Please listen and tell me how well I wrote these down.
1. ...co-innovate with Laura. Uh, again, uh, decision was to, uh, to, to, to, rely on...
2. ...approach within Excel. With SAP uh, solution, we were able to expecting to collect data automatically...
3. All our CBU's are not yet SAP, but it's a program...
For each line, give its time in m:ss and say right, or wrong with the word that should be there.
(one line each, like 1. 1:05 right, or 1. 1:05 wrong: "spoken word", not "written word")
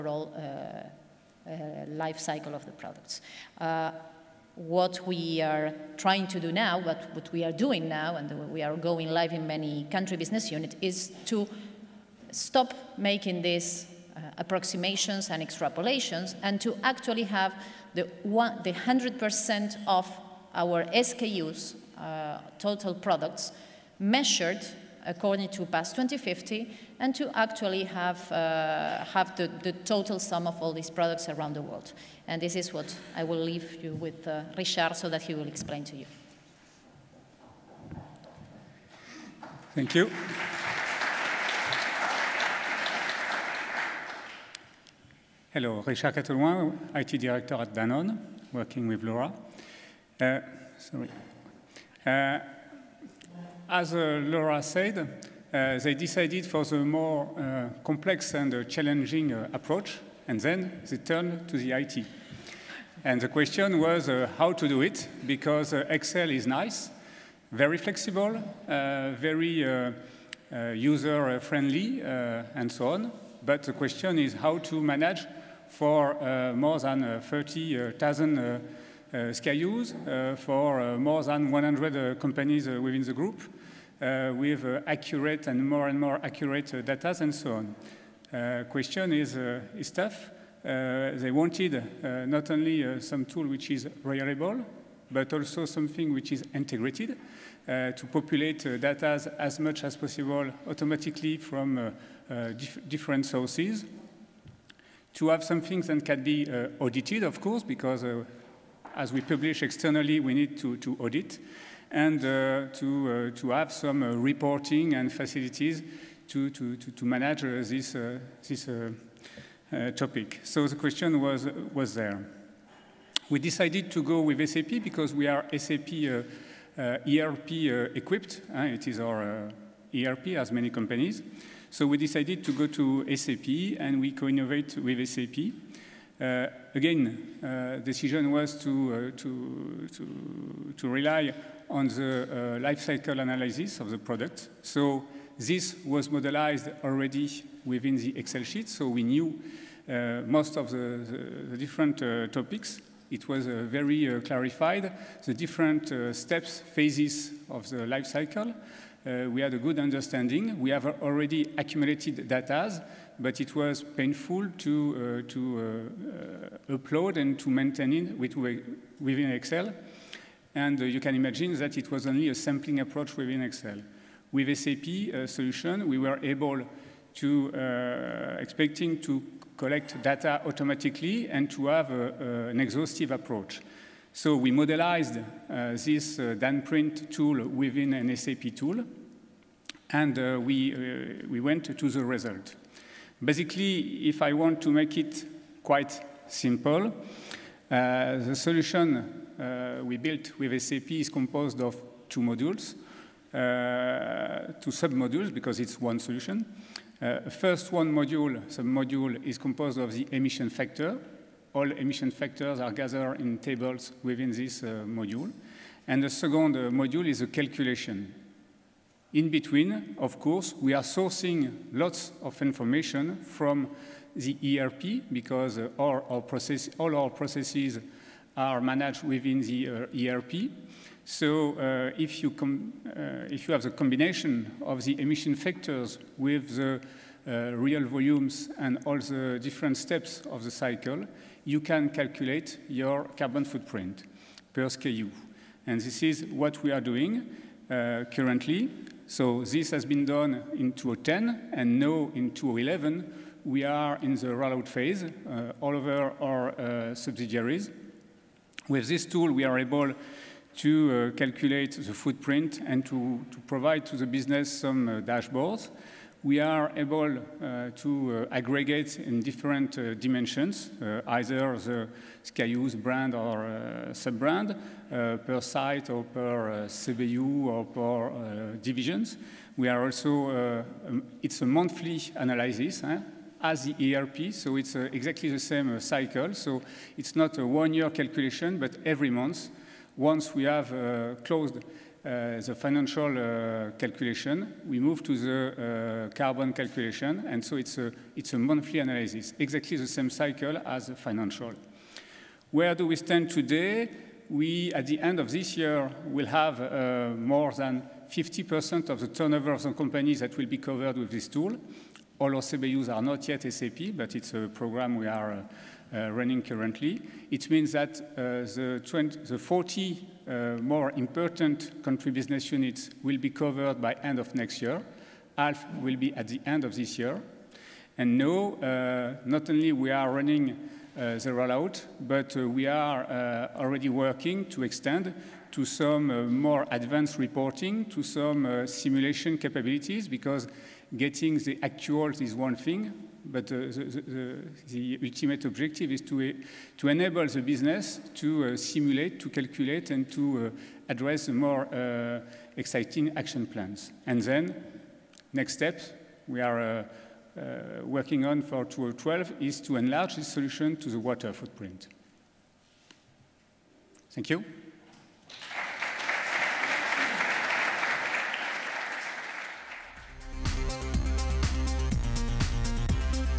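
1. 2:14 wrong: "SAP", not "Laura"
2. 2:52 right
3. 5:12 right.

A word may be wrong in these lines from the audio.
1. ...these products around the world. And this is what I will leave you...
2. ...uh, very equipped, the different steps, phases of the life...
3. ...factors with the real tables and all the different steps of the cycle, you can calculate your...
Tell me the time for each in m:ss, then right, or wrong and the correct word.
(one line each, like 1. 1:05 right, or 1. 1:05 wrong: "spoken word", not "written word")
1. 0:30 right
2. 2:33 wrong: "clarified", not "equipped"
3. 3:55 wrong: "volumes", not "tables".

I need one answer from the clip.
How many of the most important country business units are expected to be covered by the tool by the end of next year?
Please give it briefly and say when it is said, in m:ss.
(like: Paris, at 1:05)
40, at 5:19.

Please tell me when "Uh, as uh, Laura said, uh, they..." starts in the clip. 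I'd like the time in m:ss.
0:52.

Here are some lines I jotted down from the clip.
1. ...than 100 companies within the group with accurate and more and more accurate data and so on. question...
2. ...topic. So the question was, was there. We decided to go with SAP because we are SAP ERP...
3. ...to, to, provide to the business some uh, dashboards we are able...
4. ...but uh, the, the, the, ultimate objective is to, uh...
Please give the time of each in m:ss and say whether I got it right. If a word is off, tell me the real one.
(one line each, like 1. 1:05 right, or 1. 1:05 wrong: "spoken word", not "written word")
1. 1:21 right
2. 1:59 right
3. 4:22 right
4. 5:43 right.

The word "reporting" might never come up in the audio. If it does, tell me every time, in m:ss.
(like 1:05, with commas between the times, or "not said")
1:54, 5:37.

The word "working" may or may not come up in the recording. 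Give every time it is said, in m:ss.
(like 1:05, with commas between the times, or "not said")
0:48, 5:33, 5:57.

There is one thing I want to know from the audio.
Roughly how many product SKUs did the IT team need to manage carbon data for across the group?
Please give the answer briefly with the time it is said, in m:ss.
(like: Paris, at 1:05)
30,000, at 1:17.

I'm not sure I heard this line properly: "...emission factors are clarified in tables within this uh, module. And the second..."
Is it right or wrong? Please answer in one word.
wrong.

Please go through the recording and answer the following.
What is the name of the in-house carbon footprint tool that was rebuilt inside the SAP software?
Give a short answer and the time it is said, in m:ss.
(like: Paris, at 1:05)
DanPrint, at 3:06.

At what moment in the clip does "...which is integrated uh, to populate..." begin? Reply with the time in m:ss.
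1:36.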